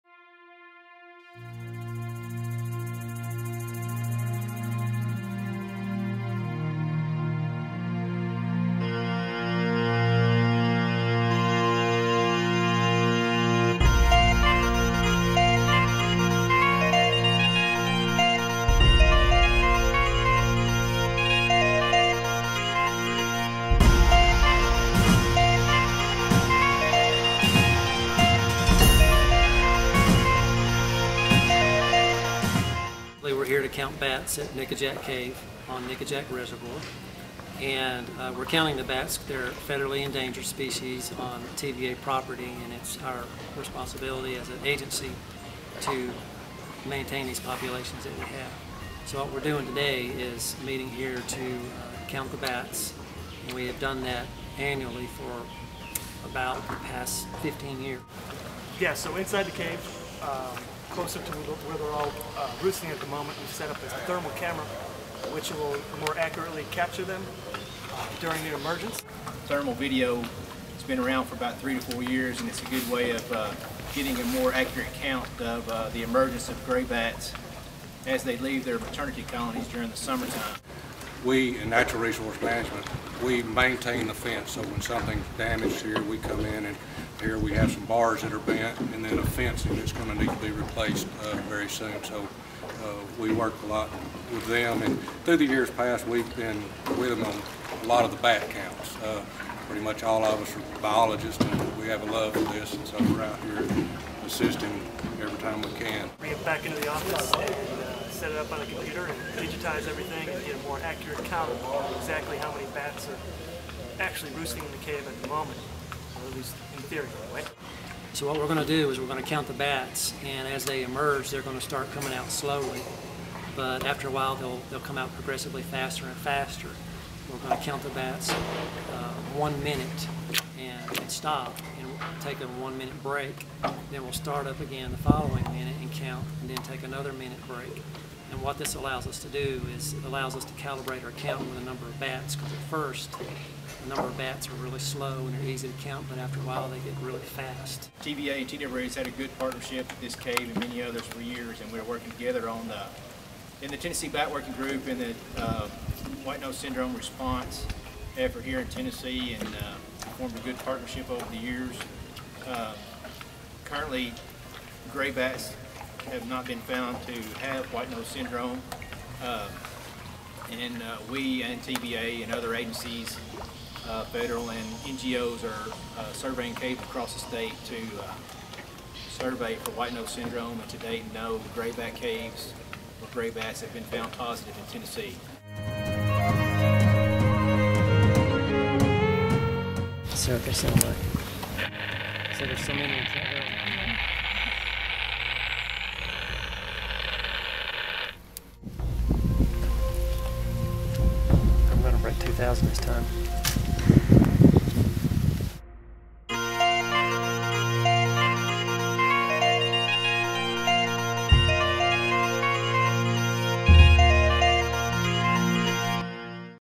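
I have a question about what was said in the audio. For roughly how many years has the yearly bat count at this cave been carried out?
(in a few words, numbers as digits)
15 years.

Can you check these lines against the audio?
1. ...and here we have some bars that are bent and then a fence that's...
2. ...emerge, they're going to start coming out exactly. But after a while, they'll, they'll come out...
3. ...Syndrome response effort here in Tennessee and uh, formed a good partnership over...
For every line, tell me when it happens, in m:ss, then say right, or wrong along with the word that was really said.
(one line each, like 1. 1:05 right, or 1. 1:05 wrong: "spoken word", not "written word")
1. 1:26 right
2. 2:00 wrong: "slowly", not "exactly"
3. 2:36 right.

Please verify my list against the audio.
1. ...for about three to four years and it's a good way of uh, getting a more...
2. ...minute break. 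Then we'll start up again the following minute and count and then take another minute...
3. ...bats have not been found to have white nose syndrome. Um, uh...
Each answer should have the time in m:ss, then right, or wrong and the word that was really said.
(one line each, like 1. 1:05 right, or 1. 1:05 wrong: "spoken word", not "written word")
1. 1:11 right
2. 2:12 right
3. 2:45 right.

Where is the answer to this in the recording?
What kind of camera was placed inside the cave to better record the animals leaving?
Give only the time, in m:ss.
1:04.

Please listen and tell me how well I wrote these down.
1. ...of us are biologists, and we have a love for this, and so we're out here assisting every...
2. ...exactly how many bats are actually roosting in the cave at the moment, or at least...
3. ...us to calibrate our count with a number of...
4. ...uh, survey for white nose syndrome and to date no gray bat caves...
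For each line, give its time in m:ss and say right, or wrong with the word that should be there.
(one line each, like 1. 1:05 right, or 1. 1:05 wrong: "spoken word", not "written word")
1. 1:40 right
2. 1:52 right
3. 2:20 right
4. 2:58 right.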